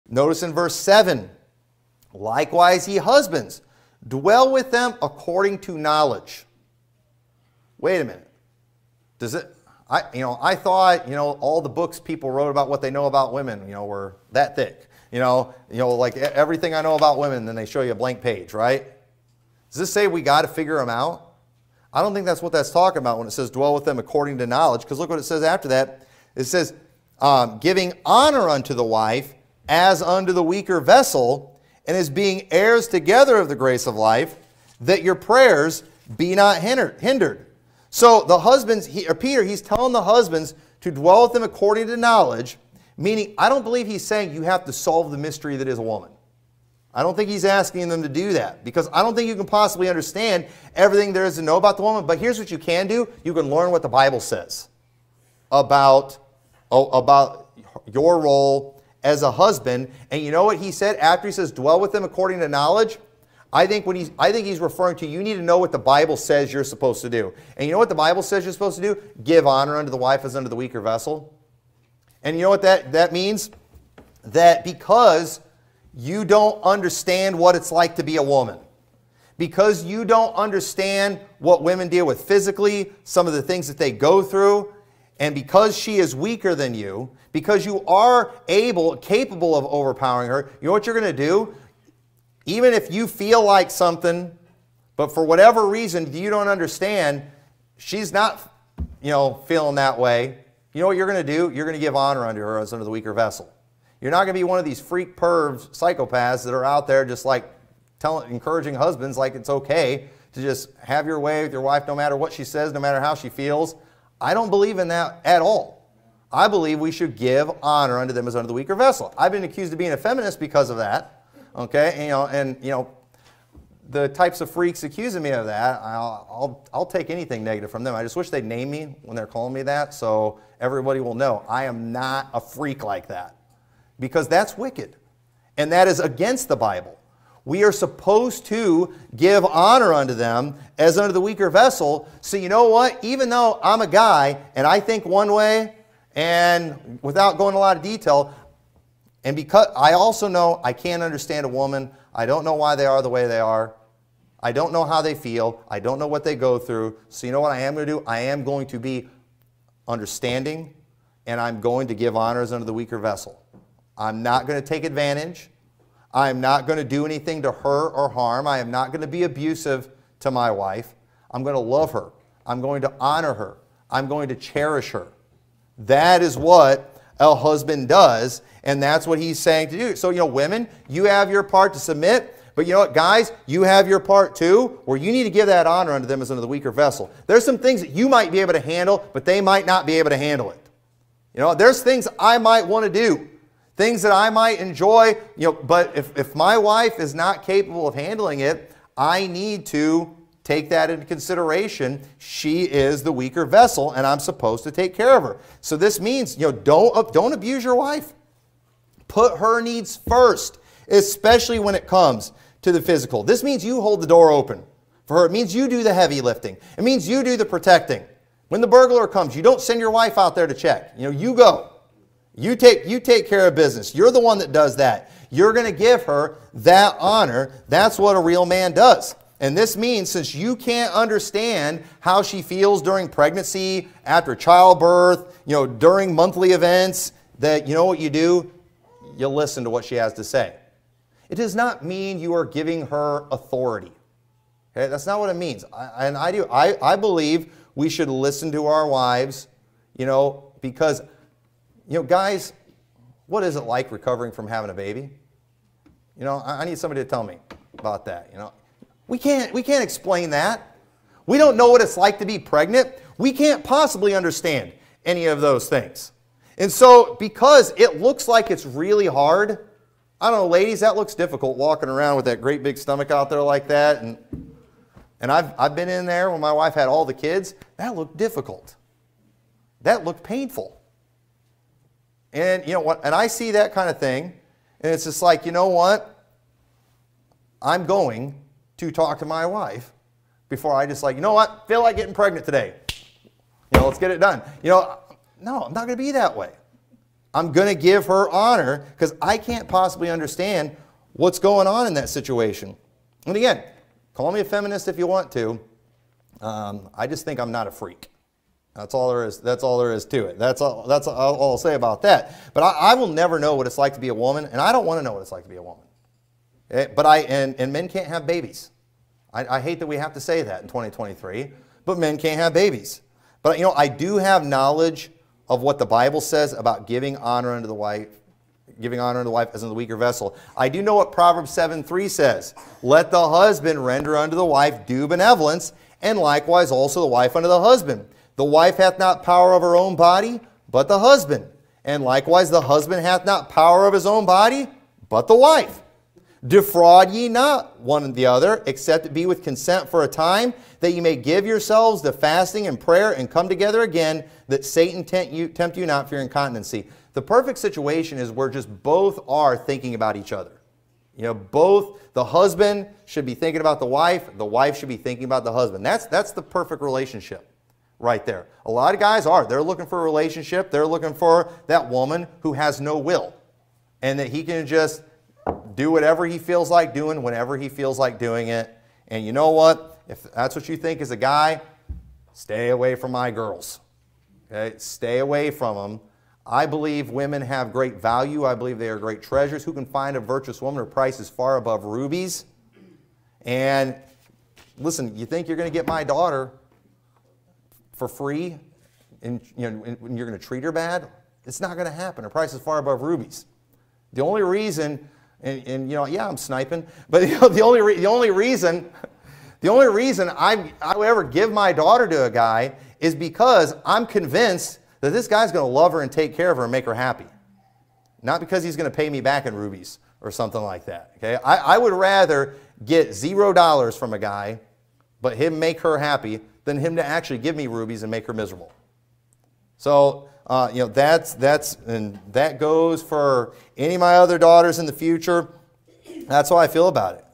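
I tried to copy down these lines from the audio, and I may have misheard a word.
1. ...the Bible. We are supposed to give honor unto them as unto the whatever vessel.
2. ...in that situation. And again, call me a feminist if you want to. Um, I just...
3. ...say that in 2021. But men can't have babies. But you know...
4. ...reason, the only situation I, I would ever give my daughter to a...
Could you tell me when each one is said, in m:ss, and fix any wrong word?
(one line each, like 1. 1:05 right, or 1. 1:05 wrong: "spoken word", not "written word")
1. 2:16 wrong: "weaker", not "whatever"
2. 5:01 right
3. 5:20 wrong: "2023", not "2021"
4. 6:48 wrong: "reason", not "situation".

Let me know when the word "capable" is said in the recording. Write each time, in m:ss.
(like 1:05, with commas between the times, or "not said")
1:28, 3:17.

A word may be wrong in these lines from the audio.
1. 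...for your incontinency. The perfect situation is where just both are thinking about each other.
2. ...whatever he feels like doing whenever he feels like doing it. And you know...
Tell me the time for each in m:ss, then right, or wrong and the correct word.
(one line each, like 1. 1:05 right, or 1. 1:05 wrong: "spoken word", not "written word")
1. 5:56 right
2. 6:15 right.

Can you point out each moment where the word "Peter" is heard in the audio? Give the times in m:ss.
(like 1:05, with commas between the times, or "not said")
0:39.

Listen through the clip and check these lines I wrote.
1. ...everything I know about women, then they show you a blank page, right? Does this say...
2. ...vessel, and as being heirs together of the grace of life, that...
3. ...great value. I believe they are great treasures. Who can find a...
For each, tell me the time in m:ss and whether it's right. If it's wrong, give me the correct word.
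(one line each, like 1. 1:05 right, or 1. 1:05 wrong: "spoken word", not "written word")
1. 0:16 right
2. 0:30 right
3. 6:27 right.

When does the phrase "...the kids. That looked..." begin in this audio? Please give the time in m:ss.
4:37.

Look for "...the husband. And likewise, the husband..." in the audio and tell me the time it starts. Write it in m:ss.
5:40.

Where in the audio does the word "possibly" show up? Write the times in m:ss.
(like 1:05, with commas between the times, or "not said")
0:49, 4:23, 4:59.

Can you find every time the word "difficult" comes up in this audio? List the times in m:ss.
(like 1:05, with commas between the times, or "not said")
4:31, 4:38.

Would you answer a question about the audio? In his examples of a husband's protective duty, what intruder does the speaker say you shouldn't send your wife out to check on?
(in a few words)
The burglar.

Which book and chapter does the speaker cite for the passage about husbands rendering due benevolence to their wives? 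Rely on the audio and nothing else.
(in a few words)
Proverbs 7:3.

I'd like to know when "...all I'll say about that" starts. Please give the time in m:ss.
5:11.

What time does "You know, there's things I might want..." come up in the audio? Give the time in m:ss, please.
3:11.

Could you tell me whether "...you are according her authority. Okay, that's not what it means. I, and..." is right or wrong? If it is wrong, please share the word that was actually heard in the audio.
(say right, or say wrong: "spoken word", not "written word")
wrong: "giving", not "according".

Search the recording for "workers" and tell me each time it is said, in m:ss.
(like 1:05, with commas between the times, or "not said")
not said.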